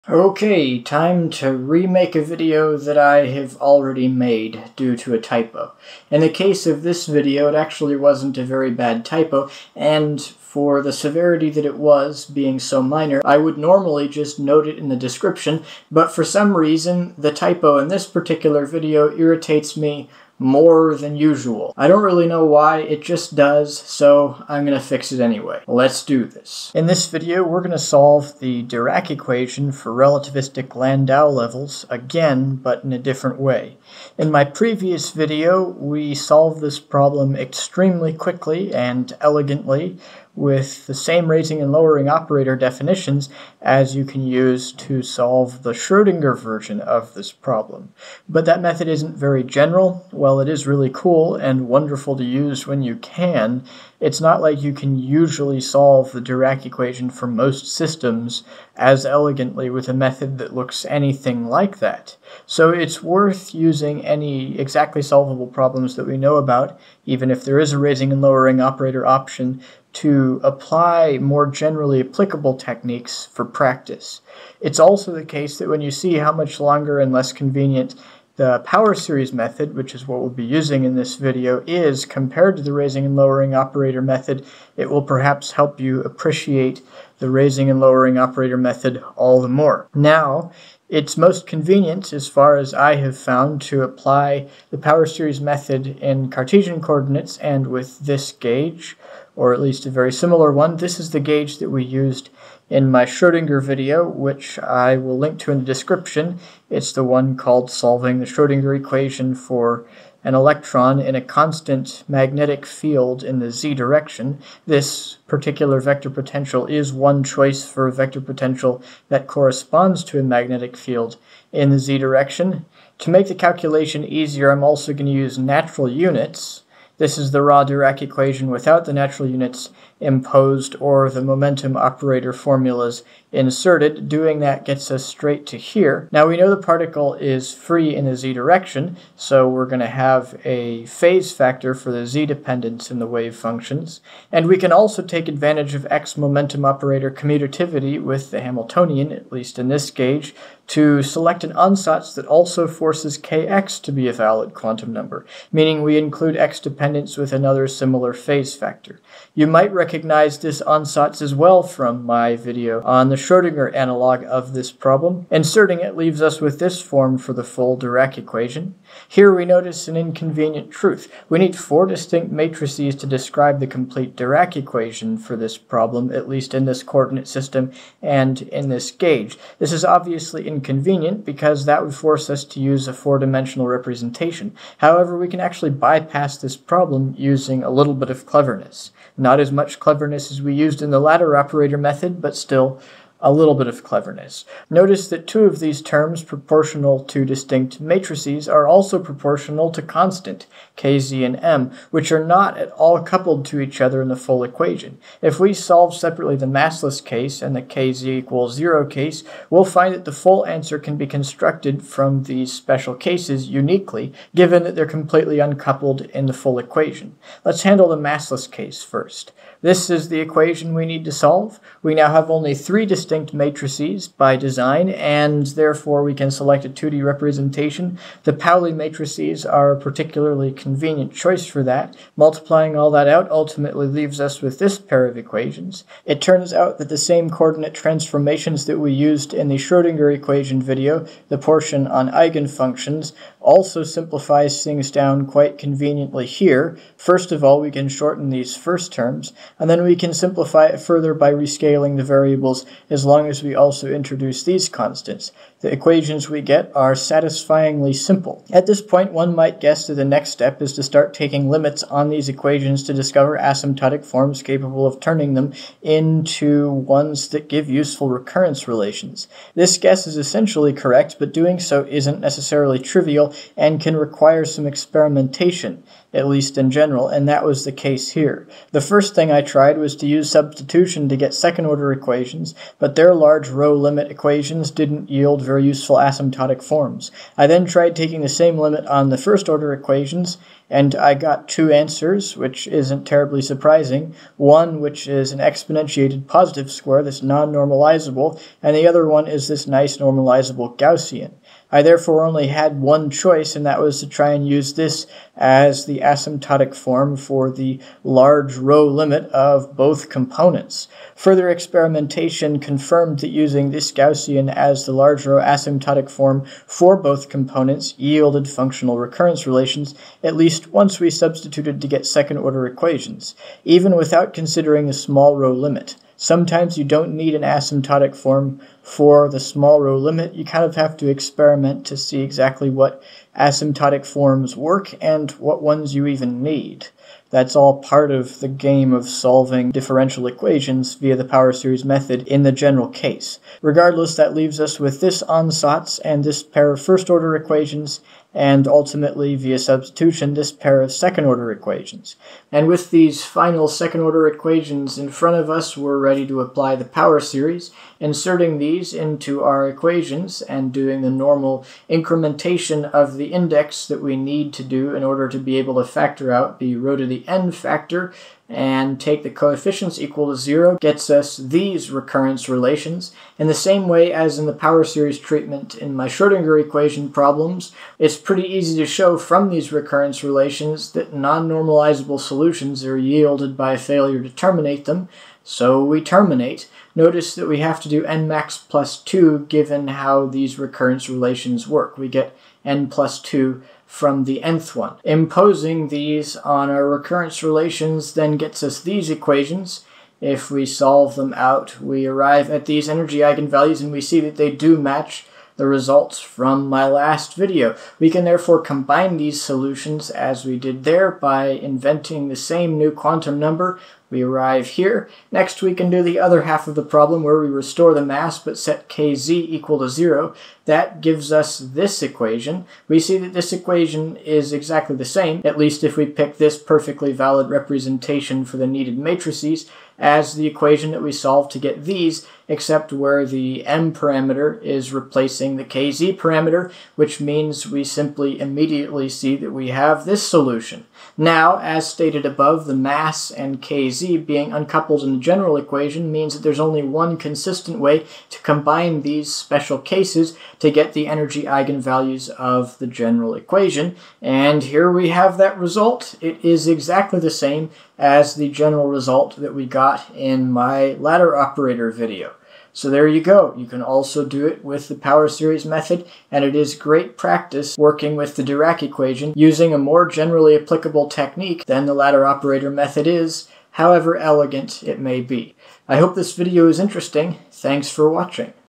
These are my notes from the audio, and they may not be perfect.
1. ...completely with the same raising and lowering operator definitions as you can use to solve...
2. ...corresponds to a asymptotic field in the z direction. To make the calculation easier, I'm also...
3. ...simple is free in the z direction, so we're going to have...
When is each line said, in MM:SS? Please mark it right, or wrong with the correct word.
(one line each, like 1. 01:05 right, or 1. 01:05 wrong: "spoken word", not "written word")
1. 00:39 wrong: "elegantly", not "completely"
2. 01:59 wrong: "magnetic", not "asymptotic"
3. 02:16 wrong: "particle", not "simple".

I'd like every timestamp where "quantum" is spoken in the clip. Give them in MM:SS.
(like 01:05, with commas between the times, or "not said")
02:34, 06:52.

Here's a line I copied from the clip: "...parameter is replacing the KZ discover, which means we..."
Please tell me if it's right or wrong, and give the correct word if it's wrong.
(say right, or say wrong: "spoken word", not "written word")
wrong: "parameter", not "discover".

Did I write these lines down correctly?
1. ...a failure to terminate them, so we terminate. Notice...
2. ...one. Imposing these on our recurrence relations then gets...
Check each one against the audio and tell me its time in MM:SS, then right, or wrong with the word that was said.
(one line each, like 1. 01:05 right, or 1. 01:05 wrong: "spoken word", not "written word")
1. 06:23 right
2. 06:34 right.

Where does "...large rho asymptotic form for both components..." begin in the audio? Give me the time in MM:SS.
05:14.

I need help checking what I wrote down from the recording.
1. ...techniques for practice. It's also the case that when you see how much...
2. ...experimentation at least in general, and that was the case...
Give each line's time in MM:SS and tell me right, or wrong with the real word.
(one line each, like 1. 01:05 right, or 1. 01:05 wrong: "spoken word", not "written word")
1. 01:12 right
2. 04:34 right.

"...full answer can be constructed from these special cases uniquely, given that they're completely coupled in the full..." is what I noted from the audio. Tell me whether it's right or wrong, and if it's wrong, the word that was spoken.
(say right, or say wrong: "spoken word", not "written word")
wrong: "uncoupled", not "coupled".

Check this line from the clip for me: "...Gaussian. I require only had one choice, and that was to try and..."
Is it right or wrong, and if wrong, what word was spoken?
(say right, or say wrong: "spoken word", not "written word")
wrong: "therefore", not "require".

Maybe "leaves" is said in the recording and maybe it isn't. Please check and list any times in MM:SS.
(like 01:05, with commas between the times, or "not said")
02:45, 03:53, 05:44.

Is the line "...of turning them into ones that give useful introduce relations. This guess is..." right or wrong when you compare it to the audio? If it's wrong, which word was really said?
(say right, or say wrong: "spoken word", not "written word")
wrong: "recurrence", not "introduce".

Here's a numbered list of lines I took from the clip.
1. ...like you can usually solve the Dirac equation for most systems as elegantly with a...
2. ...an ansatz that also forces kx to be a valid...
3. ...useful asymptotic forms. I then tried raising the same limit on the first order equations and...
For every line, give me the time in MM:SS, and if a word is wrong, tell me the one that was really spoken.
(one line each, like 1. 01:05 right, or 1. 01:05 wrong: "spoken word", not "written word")
1. 00:54 right
2. 02:31 right
3. 04:45 wrong: "taking", not "raising".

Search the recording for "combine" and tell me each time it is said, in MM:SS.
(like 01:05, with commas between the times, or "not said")
06:48, 07:28.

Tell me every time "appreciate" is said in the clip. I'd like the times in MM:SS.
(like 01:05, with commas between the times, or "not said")
01:26.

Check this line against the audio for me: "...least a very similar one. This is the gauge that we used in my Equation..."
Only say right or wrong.
wrong.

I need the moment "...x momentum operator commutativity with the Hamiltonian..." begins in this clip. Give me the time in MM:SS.
02:25.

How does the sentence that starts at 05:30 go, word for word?
You kind of have to experiment to see exactly what asymptotic forms work and what ones you even need.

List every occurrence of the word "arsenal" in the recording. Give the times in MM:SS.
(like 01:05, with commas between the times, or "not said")
not said.